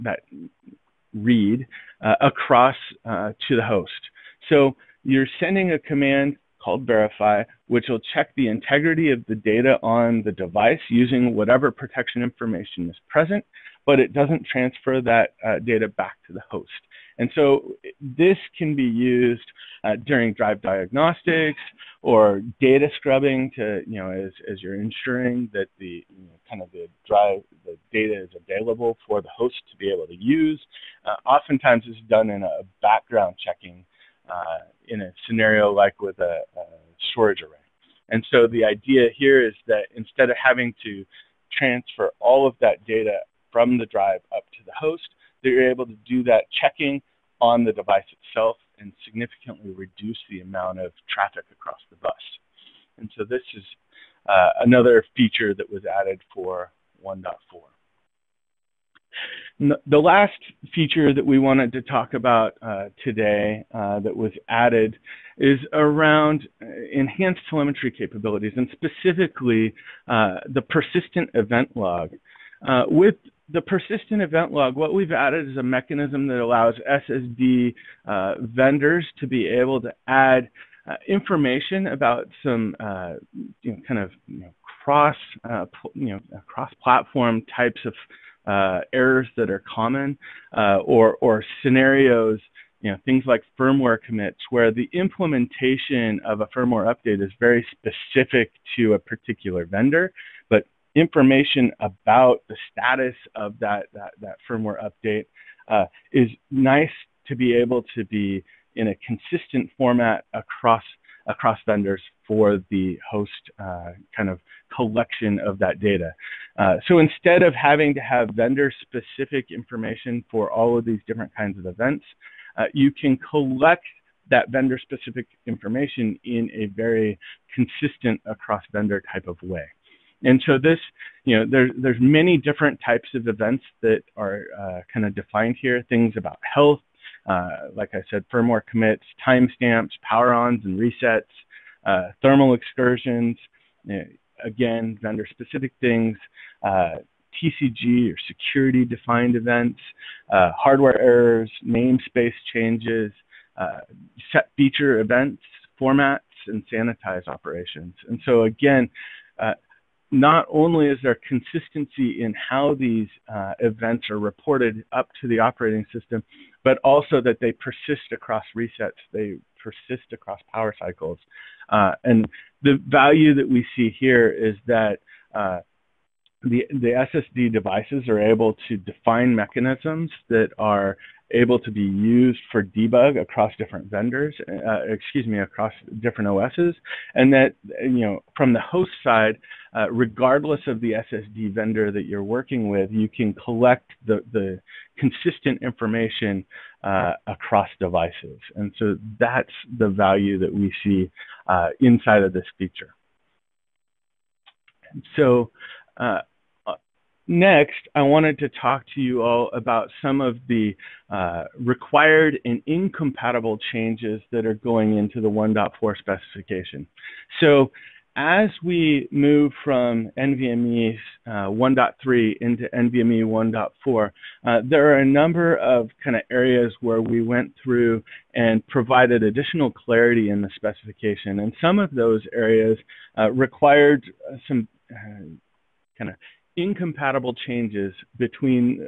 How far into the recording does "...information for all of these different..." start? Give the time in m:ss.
1:59.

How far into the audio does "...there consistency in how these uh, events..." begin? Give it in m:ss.
2:41.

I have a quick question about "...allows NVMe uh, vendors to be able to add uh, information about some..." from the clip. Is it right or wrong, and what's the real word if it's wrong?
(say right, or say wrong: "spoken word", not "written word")
wrong: "SSD", not "NVMe".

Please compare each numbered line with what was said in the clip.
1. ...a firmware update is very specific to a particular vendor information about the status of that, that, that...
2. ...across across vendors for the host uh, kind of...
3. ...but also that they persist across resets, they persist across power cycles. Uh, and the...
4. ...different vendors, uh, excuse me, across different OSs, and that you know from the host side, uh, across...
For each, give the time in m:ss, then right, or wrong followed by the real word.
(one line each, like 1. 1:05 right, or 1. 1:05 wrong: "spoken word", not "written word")
1. 1:36 right
2. 1:50 right
3. 2:46 right
4. 3:03 wrong: "regardless", not "across".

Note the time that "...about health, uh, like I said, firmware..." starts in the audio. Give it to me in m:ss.
2:16.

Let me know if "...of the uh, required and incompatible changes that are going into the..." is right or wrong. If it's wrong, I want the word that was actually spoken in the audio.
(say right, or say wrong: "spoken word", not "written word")
right.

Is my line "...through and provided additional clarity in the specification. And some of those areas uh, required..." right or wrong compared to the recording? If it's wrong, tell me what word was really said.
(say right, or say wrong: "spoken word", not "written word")
right.